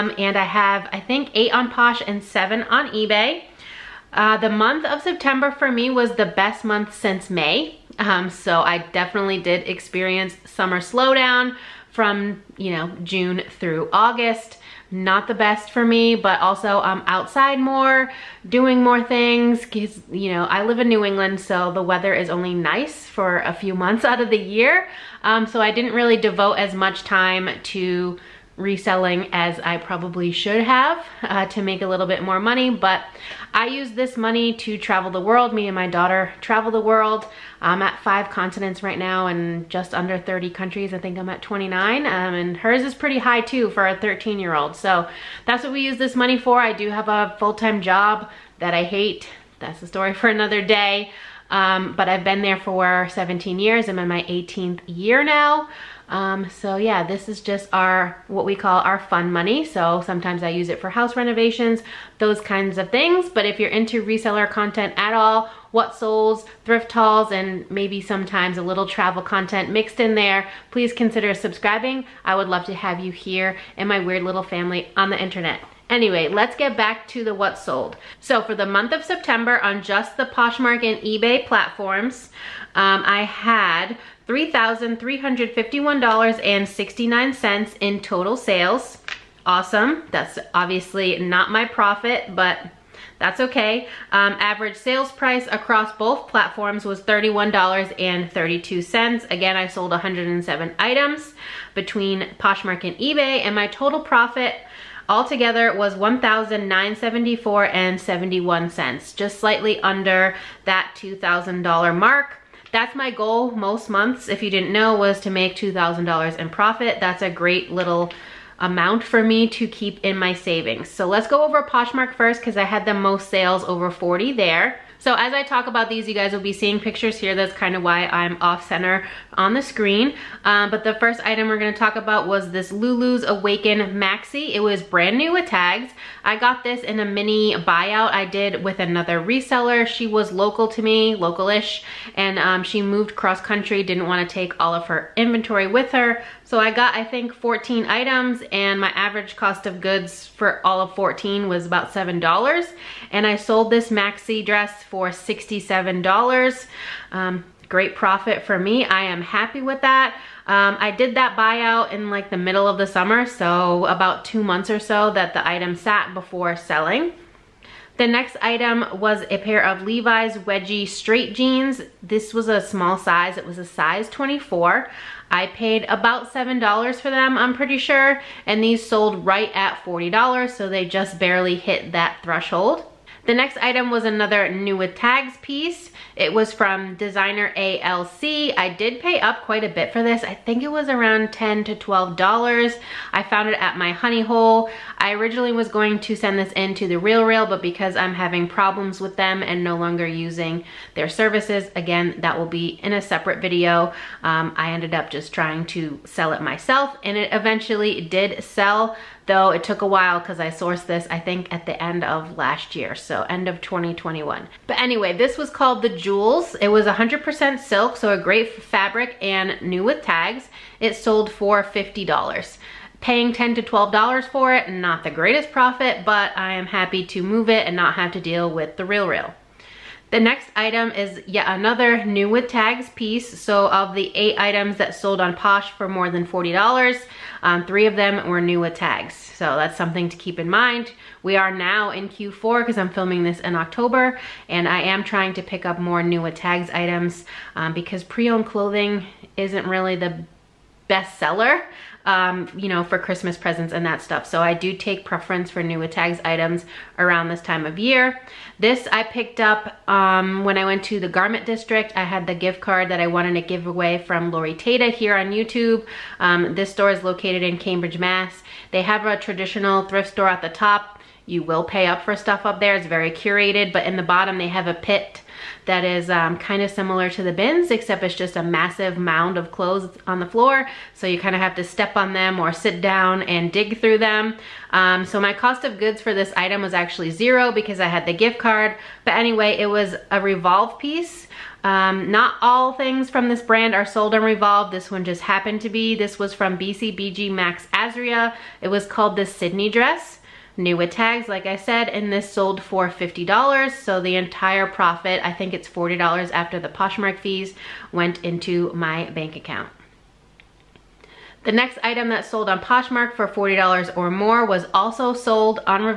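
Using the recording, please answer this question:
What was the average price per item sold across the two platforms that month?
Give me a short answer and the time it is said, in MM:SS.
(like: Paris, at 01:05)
$31.32, at 01:37.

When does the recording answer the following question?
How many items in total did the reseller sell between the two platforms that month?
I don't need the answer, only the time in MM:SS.
01:39.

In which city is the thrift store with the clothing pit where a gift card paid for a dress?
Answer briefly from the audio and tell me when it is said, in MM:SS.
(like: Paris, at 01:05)
Cambridge, at 04:27.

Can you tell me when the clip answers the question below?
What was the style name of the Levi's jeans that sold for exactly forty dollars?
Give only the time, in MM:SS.
02:50.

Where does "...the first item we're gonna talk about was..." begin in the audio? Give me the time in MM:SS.
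02:10.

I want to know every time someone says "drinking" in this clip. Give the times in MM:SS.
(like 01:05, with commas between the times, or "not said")
not said.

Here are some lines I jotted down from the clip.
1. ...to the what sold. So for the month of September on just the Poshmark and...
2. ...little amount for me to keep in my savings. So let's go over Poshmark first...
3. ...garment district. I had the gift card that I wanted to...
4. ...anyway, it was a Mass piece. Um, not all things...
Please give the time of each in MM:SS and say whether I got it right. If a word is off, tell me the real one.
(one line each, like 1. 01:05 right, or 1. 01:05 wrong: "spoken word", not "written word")
1. 01:17 right
2. 01:57 right
3. 04:21 right
4. 04:49 wrong: "Revolve", not "Mass".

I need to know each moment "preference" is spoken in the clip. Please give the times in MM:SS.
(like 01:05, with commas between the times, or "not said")
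04:15.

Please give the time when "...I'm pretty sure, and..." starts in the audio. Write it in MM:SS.
02:57.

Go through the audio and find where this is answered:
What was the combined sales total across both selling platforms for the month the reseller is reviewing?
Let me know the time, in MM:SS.
01:24.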